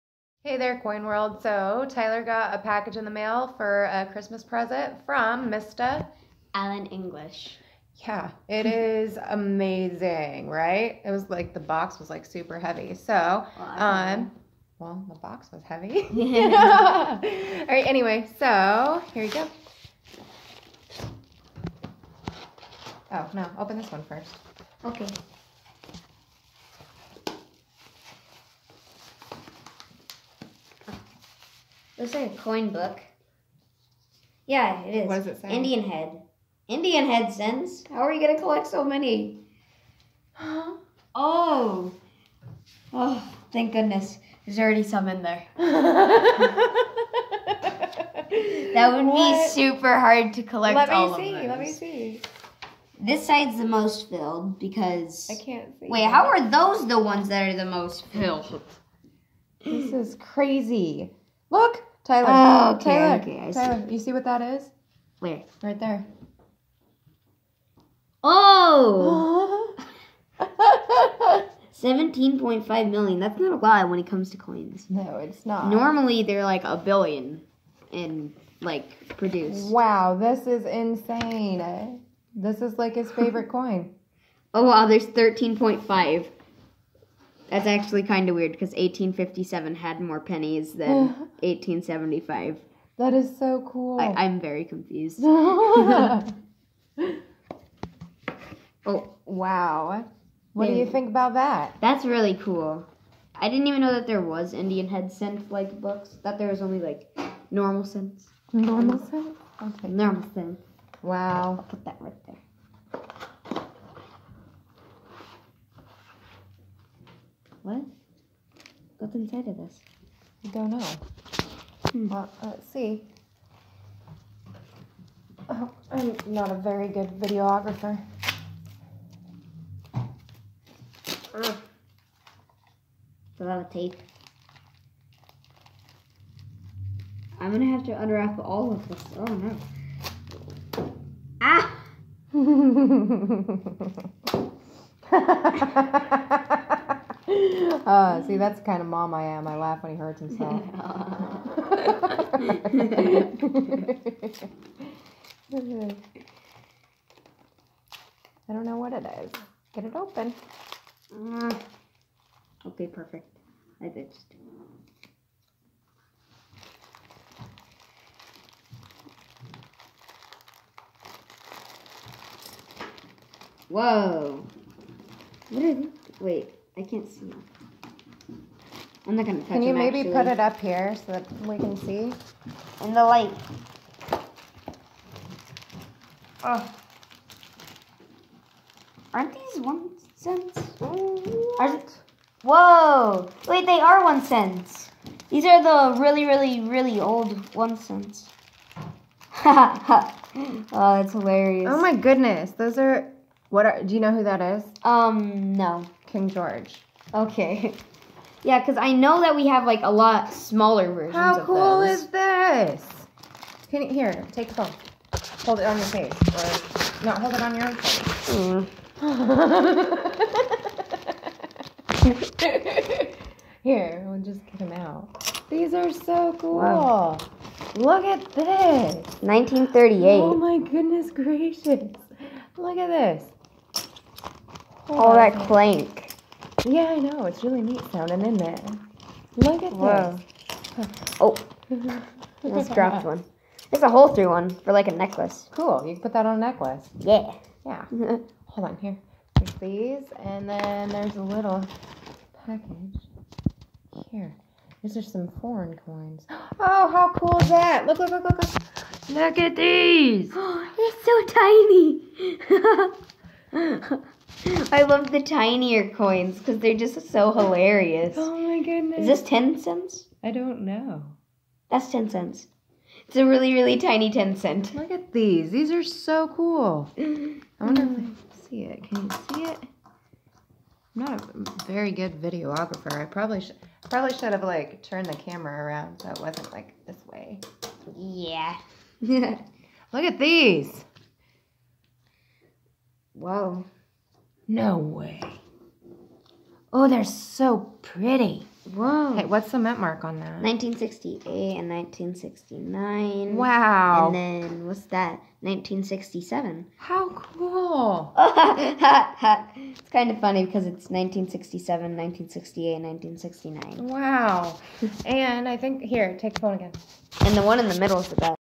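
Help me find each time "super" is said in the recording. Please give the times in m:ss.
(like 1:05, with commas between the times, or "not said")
0:12, 0:49.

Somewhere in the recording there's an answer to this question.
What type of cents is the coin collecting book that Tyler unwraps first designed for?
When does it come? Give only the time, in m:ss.
0:36.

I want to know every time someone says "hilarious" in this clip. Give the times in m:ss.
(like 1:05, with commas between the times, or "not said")
3:21, 4:27.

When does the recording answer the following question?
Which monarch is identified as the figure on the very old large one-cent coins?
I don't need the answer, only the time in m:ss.
3:26.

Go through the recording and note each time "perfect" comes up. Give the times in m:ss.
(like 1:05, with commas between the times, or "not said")
2:42.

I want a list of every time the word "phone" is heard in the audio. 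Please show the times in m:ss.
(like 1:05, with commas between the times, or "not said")
3:34, 5:16.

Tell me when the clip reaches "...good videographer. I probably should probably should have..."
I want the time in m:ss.
4:41.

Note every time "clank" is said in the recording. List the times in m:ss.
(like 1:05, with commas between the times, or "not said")
3:55.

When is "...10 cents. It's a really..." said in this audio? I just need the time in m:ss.
4:31.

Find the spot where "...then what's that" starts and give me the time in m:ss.
5:04.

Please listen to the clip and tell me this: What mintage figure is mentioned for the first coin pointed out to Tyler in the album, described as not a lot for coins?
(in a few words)
17.5 million.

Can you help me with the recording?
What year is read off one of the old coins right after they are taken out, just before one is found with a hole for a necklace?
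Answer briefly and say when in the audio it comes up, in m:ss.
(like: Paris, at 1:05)
1938, at 3:49.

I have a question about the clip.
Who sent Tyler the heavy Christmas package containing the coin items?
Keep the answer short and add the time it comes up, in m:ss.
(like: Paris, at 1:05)
Alan English, at 0:05.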